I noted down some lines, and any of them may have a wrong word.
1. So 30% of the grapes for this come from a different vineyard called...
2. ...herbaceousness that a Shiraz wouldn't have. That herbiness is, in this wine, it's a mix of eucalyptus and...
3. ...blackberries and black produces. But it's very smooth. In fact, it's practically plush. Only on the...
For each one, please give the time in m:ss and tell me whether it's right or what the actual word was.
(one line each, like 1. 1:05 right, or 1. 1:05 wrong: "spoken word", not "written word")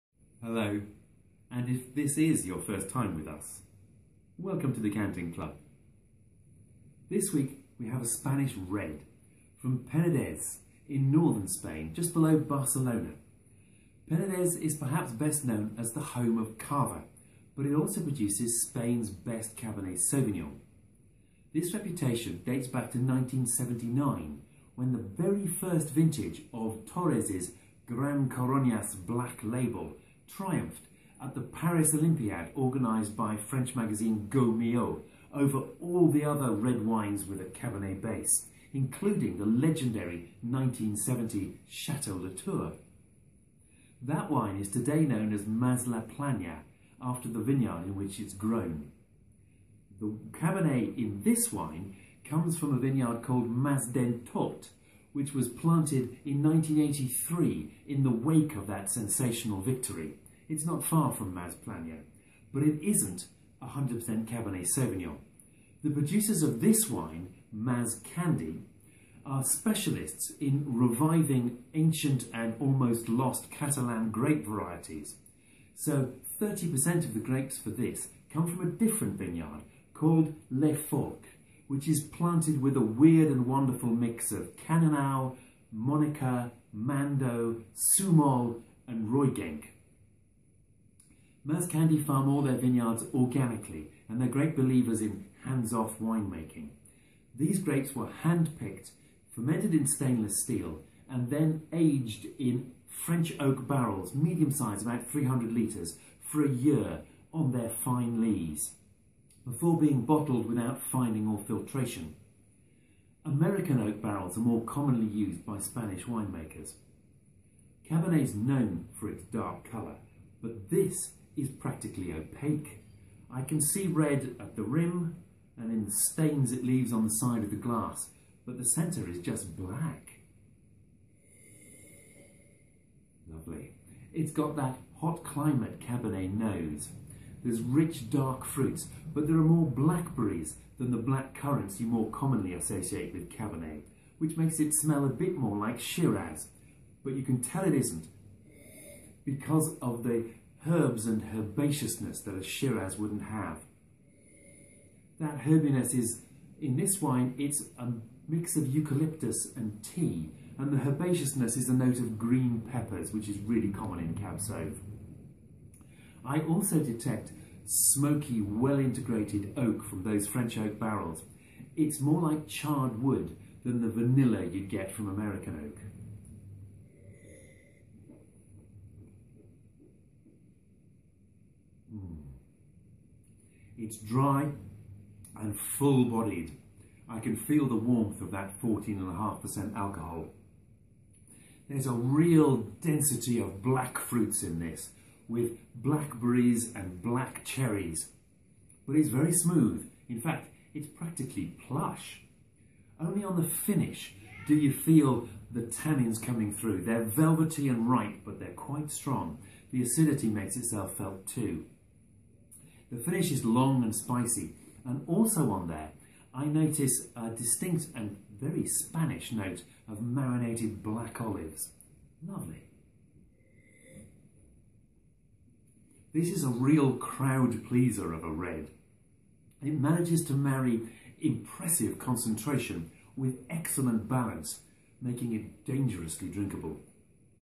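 1. 1:15 right
2. 2:31 right
3. 3:15 wrong: "cherries", not "produces".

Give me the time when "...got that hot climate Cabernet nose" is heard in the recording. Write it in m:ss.
2:14.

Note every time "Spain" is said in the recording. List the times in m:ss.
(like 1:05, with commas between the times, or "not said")
0:11, 0:18.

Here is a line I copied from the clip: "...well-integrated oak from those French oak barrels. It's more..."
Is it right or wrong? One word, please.
right.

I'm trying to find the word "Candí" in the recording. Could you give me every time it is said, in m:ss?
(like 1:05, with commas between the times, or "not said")
1:08, 1:31.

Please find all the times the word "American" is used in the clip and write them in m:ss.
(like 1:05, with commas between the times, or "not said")
1:53, 2:55.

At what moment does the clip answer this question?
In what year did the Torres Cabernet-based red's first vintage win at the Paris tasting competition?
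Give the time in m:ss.
0:22.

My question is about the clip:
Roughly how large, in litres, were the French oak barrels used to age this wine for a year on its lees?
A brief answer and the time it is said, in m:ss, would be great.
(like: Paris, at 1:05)
300 litres, at 1:45.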